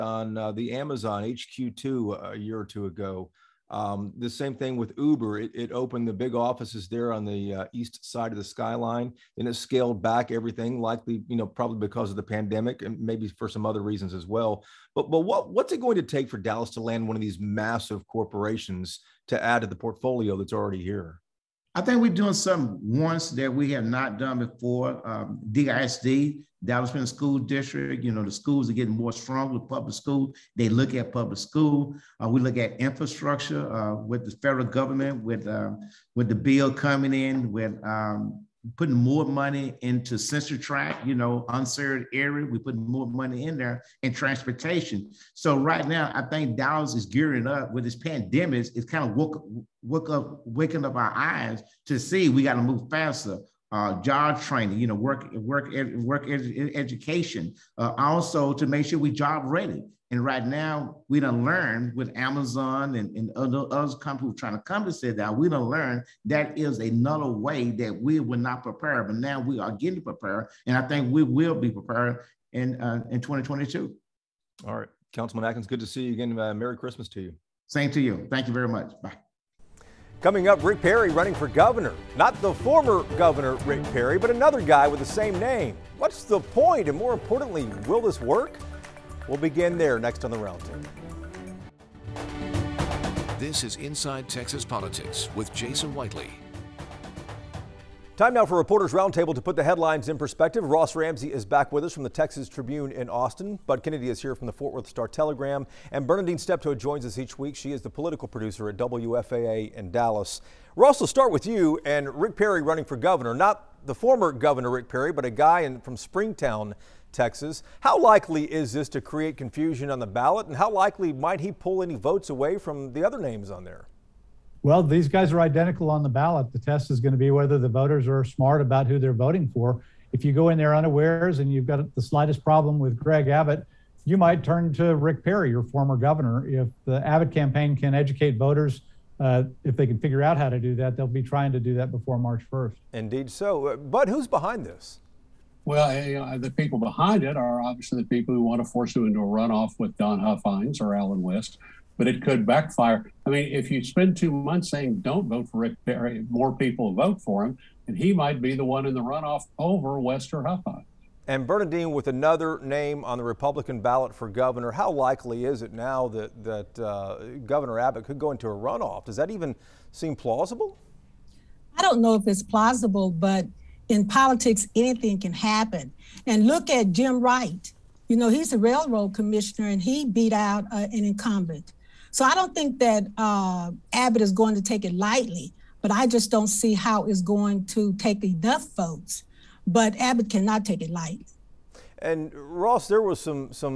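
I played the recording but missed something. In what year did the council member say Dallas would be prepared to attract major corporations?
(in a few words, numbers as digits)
2022.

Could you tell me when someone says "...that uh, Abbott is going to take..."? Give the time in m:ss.
3:02.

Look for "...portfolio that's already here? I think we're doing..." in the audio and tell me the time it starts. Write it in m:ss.
0:19.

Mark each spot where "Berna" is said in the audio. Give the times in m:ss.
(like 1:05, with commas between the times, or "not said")
1:46, 2:41.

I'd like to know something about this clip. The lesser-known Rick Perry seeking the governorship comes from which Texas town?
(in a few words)
Springtown.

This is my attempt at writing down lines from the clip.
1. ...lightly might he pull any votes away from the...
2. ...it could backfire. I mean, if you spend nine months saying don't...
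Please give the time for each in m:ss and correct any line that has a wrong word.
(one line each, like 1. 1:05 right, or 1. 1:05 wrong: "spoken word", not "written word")
1. 2:00 wrong: "likely", not "lightly"
2. 2:32 wrong: "two", not "nine".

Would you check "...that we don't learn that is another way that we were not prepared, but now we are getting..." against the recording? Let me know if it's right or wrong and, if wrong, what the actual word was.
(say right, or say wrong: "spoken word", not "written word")
right.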